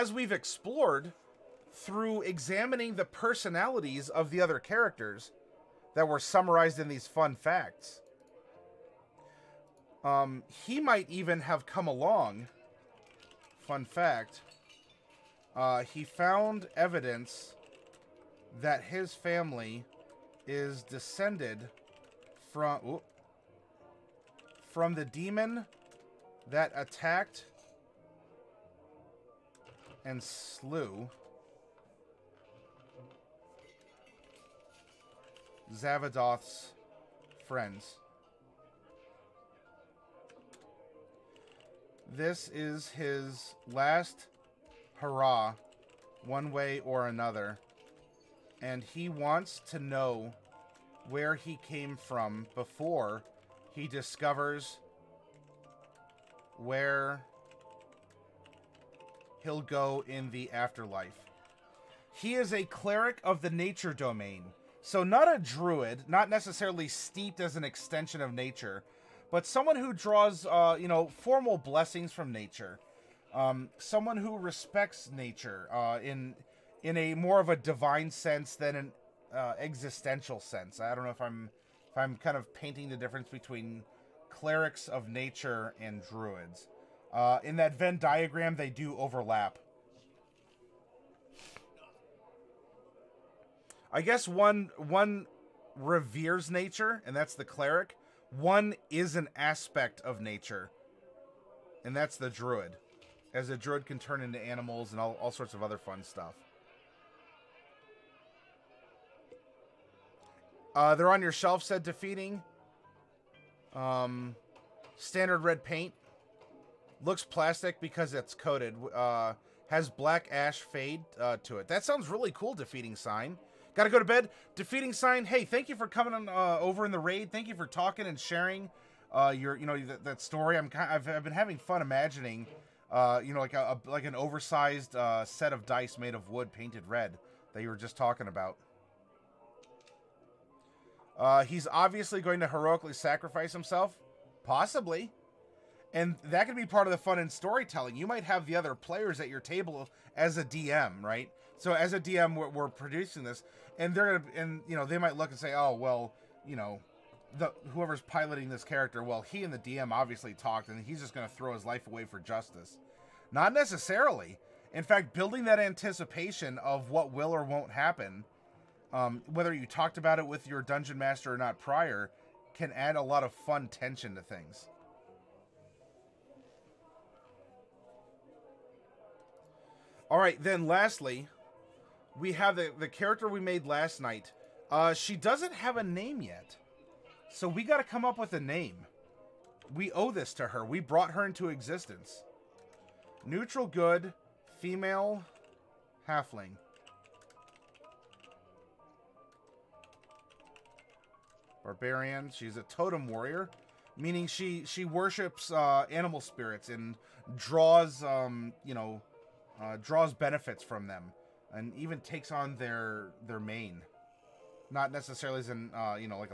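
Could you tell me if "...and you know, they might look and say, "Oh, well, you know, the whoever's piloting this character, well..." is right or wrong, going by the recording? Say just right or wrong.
right.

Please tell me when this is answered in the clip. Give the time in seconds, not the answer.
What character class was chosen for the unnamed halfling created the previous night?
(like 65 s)
201 s.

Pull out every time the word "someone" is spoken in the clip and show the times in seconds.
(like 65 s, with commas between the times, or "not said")
69 s, 73 s.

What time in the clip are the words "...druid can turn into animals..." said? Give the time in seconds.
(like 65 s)
103 s.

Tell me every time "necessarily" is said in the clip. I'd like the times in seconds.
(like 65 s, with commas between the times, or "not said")
66 s, 163 s, 214 s.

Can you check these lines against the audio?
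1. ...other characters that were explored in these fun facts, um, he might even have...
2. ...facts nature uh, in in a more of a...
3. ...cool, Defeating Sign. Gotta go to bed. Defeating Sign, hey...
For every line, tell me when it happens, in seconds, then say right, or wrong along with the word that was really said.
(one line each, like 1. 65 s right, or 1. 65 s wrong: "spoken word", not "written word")
1. 4 s wrong: "summarized", not "explored"
2. 74 s wrong: "respects", not "facts"
3. 122 s right.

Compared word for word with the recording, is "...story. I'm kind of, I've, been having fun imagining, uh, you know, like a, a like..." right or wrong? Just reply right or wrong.
right.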